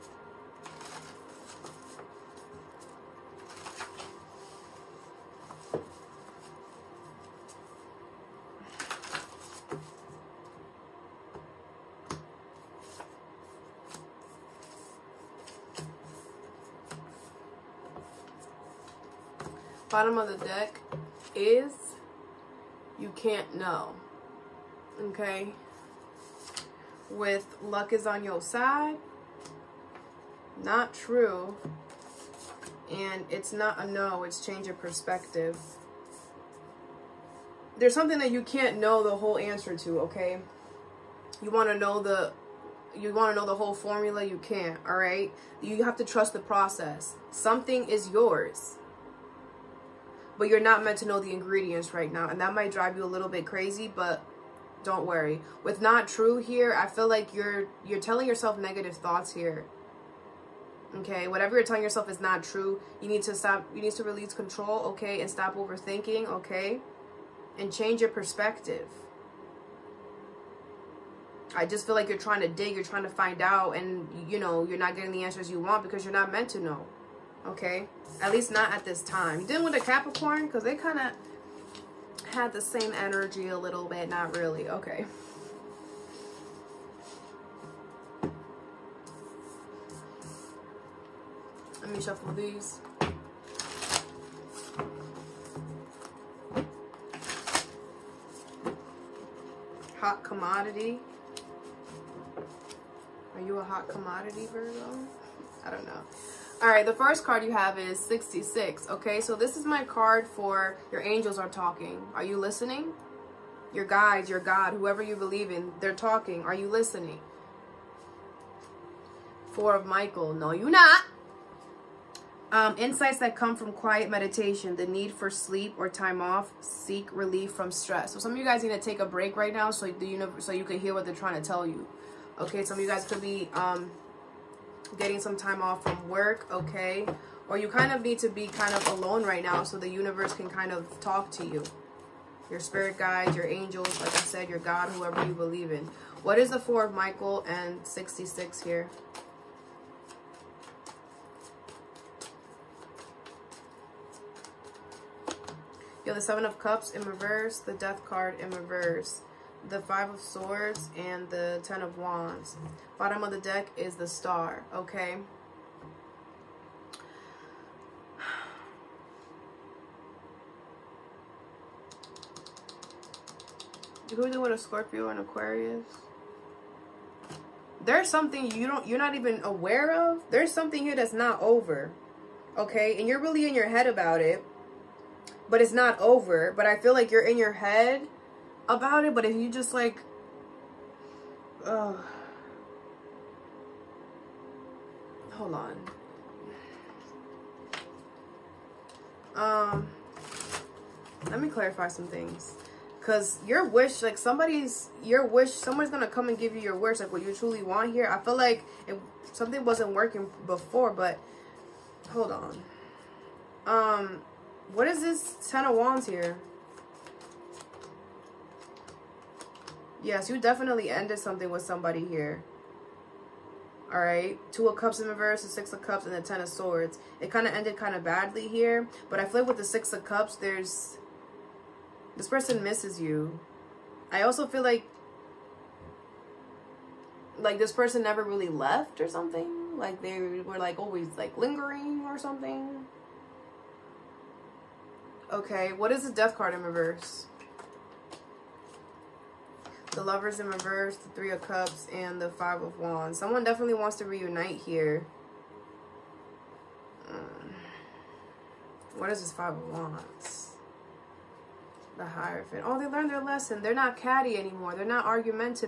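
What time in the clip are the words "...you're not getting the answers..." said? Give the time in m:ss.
1:14.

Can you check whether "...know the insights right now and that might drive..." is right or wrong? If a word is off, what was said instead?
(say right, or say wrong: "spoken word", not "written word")
wrong: "ingredients", not "insights".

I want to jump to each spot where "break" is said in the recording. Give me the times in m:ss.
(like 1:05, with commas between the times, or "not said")
2:09.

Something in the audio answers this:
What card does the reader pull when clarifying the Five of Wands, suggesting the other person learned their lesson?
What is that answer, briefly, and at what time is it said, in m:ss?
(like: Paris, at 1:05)
The Hierophant, at 4:21.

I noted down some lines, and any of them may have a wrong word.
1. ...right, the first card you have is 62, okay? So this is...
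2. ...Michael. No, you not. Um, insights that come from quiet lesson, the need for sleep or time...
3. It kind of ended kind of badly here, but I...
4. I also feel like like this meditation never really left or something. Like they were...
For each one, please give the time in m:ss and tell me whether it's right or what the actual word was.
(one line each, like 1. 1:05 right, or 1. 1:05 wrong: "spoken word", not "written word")
1. 1:46 wrong: "66", not "62"
2. 1:59 wrong: "meditation", not "lesson"
3. 3:47 right
4. 3:54 wrong: "person", not "meditation".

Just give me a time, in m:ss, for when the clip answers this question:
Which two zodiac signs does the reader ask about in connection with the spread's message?
2:54.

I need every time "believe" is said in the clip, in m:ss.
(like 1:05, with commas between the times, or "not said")
1:55, 2:25.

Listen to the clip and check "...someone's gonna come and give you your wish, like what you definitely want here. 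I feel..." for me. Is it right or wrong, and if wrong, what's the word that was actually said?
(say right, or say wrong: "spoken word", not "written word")
wrong: "truly", not "definitely".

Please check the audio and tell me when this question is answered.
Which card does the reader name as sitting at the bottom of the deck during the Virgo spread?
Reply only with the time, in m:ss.
2:43.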